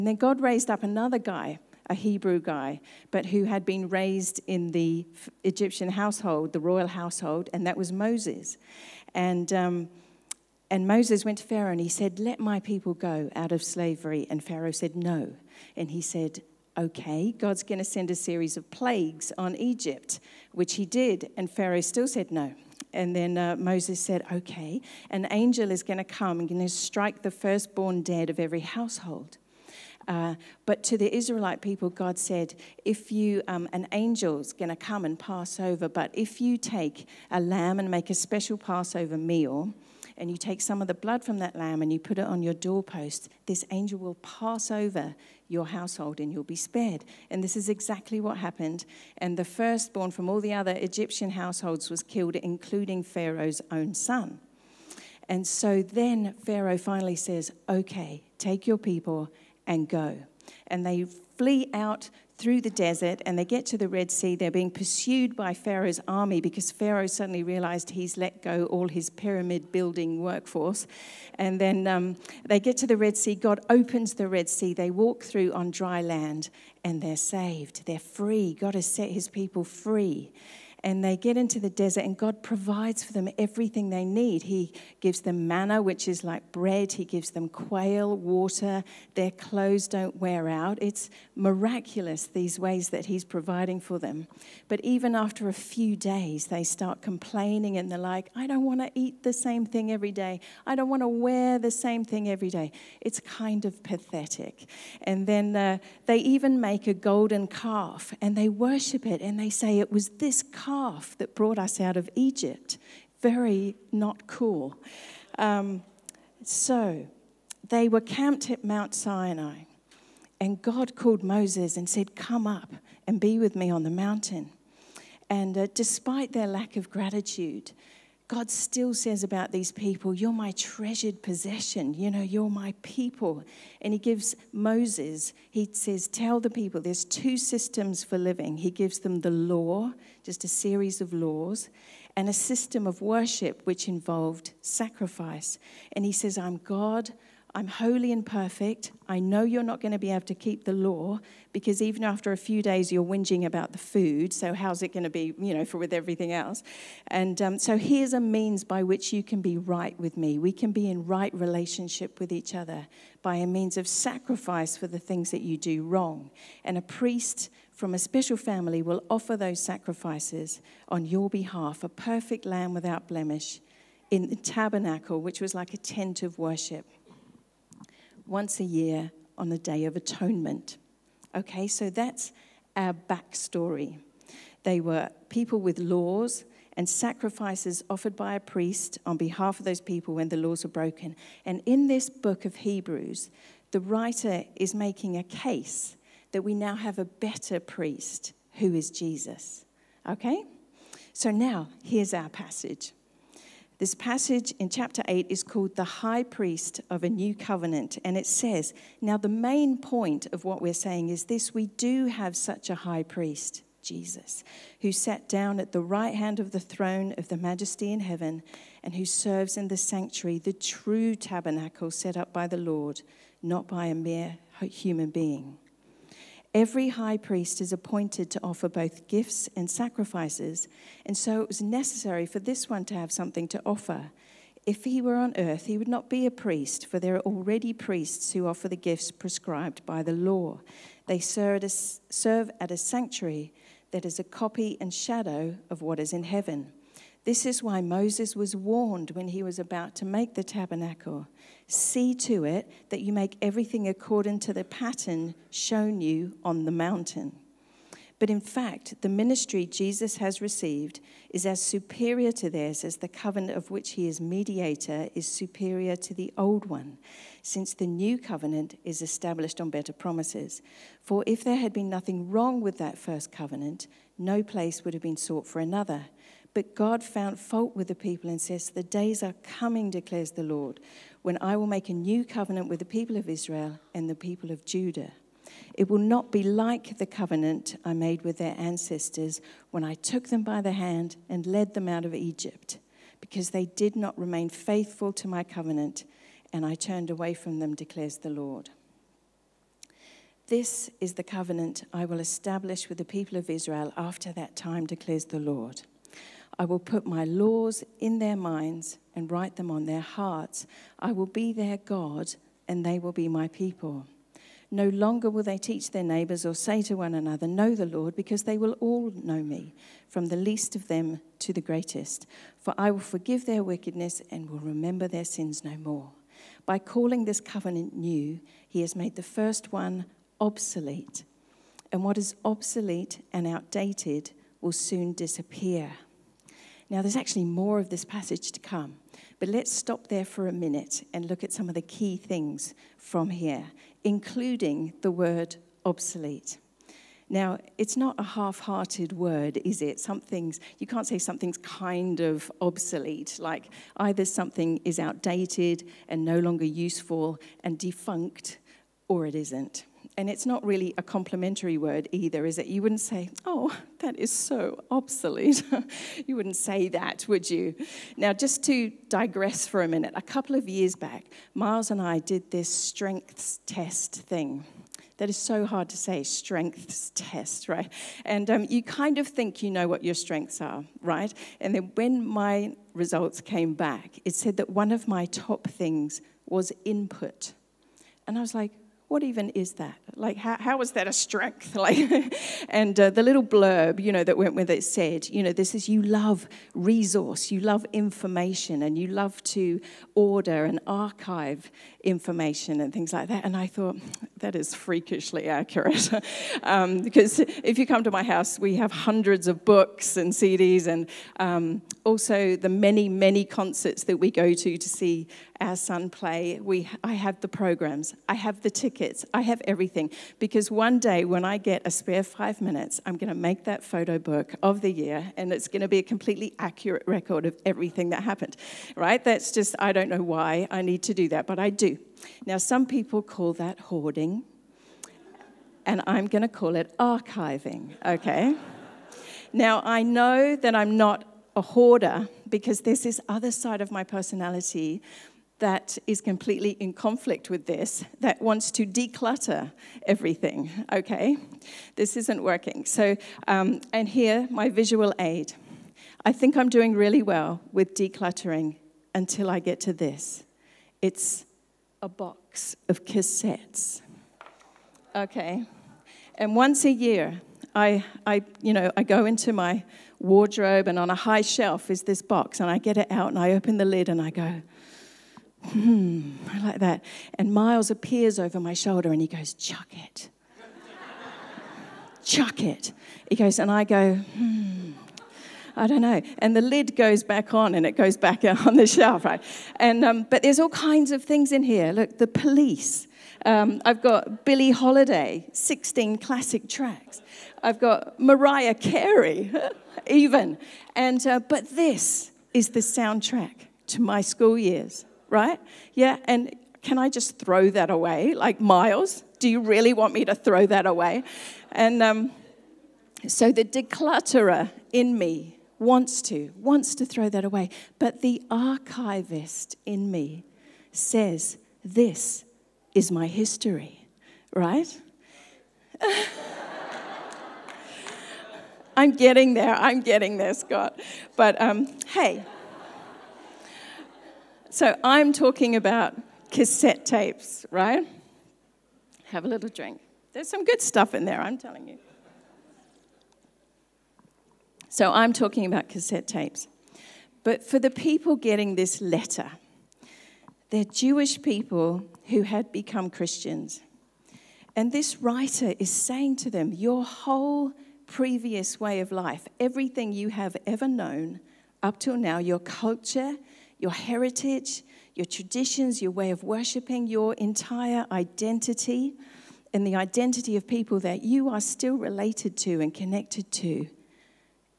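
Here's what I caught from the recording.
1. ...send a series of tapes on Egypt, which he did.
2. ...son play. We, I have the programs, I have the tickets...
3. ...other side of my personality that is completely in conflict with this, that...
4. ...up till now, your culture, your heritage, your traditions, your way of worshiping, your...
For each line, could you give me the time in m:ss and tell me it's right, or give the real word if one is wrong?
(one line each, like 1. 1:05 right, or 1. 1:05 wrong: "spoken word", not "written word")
1. 0:17 wrong: "plagues", not "tapes"
2. 6:55 right
3. 7:23 right
4. 9:21 right.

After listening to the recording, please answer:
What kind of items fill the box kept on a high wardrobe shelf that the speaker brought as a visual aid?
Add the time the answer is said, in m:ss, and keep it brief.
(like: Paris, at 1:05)
cassettes, at 7:43.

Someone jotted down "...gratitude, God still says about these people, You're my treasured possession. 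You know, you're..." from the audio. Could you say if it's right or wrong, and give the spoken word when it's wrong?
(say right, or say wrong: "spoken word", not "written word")
right.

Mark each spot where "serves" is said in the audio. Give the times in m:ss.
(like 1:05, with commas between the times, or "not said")
3:39, 4:01.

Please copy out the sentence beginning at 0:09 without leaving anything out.
And um, and Moses went to Pharaoh and he said, Let my people go out of slavery.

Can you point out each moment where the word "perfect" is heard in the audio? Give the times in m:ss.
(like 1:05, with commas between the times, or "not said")
2:28, 2:51.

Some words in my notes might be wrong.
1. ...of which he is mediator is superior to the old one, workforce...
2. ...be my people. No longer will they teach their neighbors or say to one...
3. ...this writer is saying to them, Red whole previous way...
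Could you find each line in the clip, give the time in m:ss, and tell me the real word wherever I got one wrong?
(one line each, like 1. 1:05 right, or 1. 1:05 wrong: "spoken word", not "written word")
1. 4:23 wrong: "since", not "workforce"
2. 5:13 right
3. 9:14 wrong: "Your", not "Red".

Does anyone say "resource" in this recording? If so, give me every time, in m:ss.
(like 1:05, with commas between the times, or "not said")
6:36.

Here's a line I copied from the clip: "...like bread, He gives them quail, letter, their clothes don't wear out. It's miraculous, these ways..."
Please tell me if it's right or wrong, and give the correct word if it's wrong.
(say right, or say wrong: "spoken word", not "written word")
wrong: "water", not "letter".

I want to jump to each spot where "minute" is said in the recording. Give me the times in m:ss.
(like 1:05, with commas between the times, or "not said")
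5:40, 6:09, 7:02.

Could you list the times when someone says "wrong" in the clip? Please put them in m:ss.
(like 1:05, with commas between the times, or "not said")
2:45, 4:32.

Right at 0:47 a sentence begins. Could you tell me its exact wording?
And this is exactly what happened.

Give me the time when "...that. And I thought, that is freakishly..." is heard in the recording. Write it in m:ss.
6:43.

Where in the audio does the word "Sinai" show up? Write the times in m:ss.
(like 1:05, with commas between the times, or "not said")
1:58.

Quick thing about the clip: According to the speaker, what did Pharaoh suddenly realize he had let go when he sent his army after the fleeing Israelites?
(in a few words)
pyramid building workforce.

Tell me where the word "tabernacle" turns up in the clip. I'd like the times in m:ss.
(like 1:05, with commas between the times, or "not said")
2:54, 3:41, 4:10.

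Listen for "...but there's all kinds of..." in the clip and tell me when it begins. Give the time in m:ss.
8:10.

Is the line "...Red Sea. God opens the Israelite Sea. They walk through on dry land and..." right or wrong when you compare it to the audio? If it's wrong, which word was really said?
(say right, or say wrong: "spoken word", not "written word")
wrong: "Red", not "Israelite".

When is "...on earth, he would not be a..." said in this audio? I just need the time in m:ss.
3:55.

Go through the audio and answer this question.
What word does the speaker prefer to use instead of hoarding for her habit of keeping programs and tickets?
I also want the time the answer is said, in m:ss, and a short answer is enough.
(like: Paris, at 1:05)
archiving, at 7:16.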